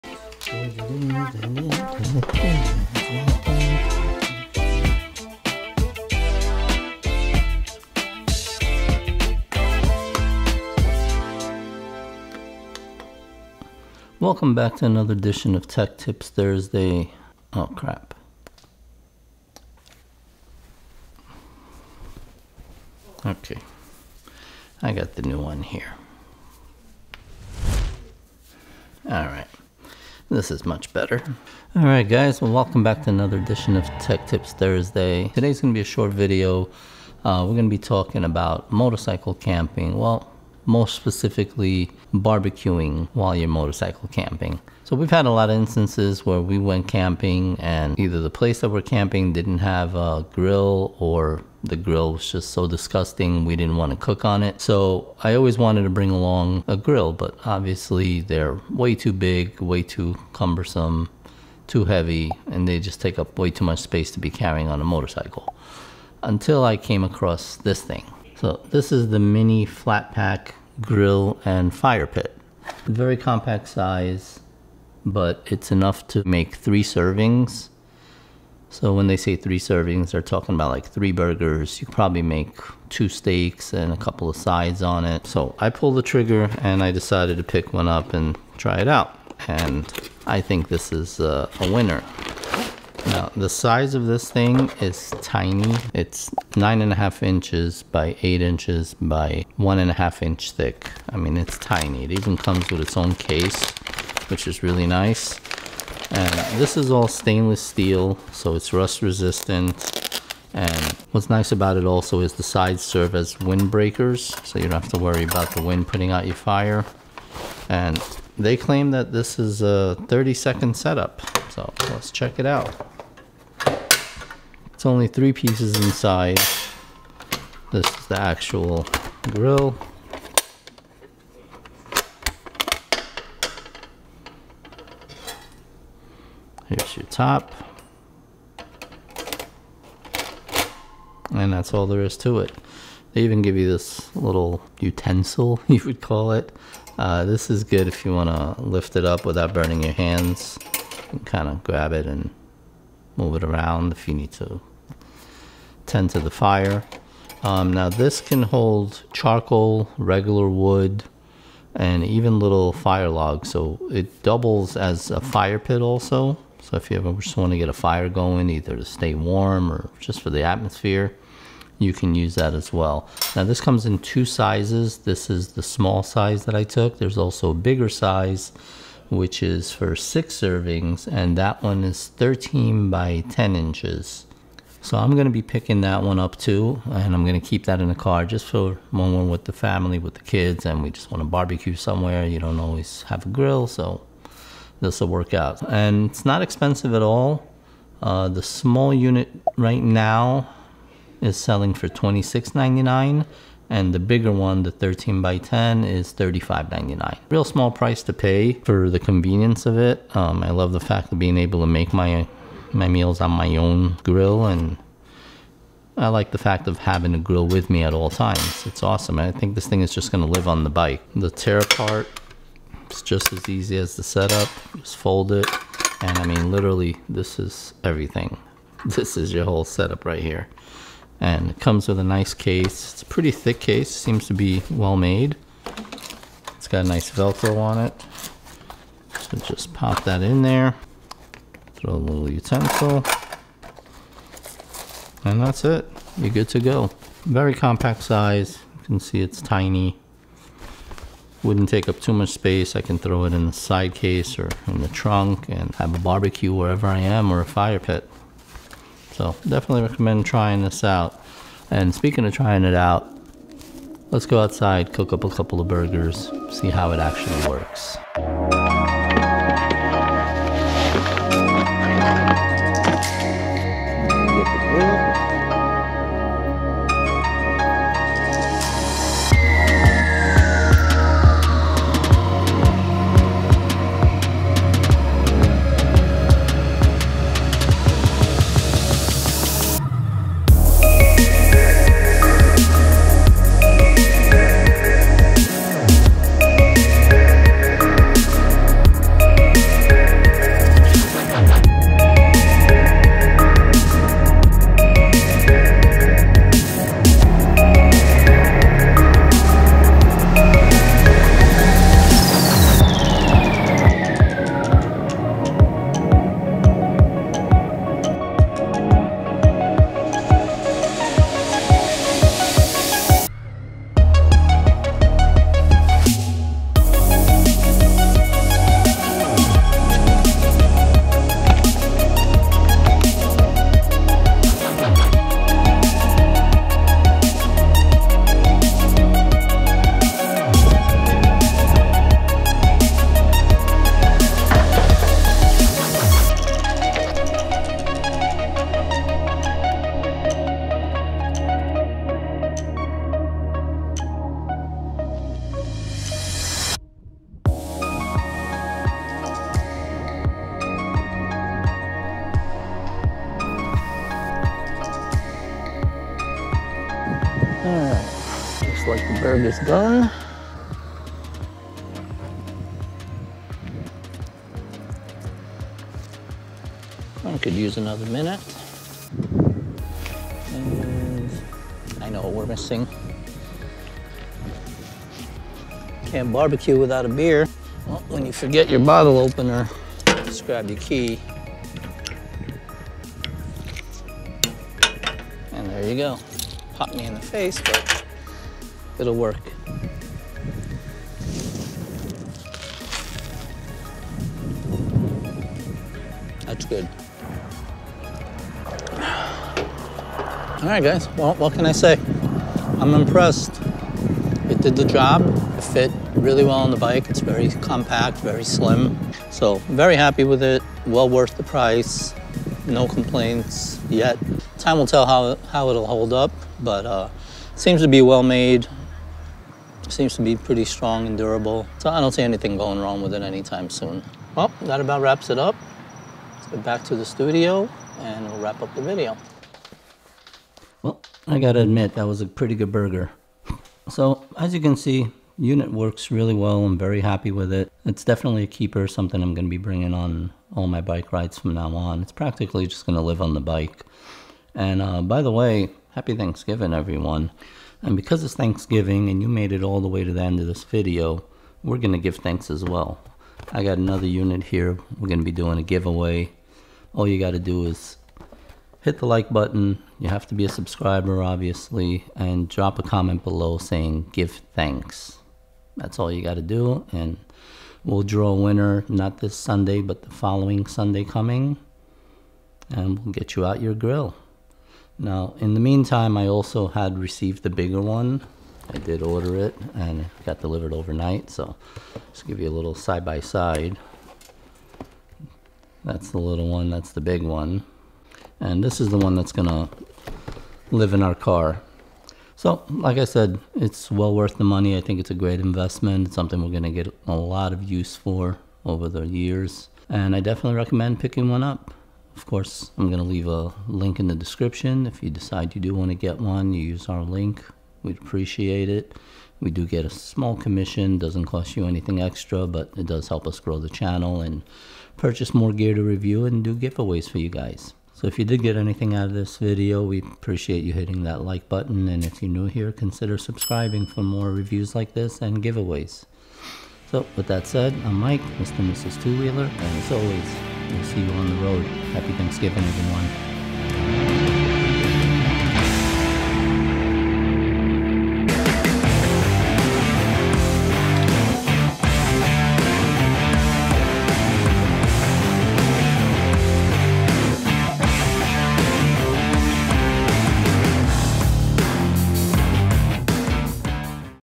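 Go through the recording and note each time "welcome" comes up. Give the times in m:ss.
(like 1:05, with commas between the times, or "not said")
0:14, 0:32.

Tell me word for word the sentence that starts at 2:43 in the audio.
So it doubles as a fire pit also.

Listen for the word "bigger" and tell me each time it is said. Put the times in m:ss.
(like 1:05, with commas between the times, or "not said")
2:57, 3:23, 8:07.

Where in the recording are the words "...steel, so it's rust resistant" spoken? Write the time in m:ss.
1:47.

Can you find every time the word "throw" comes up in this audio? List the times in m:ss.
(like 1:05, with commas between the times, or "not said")
4:01, 4:12.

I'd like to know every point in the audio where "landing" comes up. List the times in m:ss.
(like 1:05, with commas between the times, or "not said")
not said.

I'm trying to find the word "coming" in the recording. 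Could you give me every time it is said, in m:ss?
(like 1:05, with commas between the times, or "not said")
8:01.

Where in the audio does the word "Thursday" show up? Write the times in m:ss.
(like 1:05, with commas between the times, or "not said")
0:16, 0:34.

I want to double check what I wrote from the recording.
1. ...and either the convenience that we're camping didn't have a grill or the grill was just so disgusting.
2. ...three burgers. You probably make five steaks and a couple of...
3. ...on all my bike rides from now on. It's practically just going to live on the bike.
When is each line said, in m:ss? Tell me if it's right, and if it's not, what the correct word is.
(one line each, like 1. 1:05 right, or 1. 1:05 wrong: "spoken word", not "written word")
1. 0:47 wrong: "place", not "convenience"
2. 1:20 wrong: "two", not "five"
3. 7:29 right.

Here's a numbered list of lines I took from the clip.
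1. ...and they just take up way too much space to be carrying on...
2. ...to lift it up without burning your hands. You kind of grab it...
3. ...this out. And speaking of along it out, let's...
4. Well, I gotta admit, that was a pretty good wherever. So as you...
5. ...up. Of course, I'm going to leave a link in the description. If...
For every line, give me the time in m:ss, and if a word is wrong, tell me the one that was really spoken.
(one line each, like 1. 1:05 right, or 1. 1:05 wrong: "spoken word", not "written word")
1. 1:02 right
2. 2:28 right
3. 4:20 wrong: "trying", not "along"
4. 7:20 wrong: "burger", not "wherever"
5. 8:31 right.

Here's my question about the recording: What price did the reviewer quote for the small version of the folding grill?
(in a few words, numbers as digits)
$26.99.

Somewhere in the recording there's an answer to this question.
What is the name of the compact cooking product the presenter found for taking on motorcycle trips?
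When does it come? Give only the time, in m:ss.
1:09.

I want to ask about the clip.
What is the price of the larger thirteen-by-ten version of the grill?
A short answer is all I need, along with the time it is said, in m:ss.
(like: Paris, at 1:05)
$35.99, at 3:26.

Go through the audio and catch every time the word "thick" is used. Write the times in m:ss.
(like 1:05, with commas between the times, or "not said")
1:40, 3:53.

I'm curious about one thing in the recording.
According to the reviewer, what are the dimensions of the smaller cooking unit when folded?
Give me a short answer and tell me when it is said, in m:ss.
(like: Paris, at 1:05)
9.5 by 8 by 1.5 inches, at 1:36.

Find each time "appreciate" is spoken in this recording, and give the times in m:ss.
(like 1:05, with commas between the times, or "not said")
8:37, 8:49.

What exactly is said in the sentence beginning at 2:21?
And that's all there is to it.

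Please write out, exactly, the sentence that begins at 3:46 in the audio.
And I mean, literally, this is everything.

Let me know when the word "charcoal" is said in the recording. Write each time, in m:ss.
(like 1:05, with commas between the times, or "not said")
2:39.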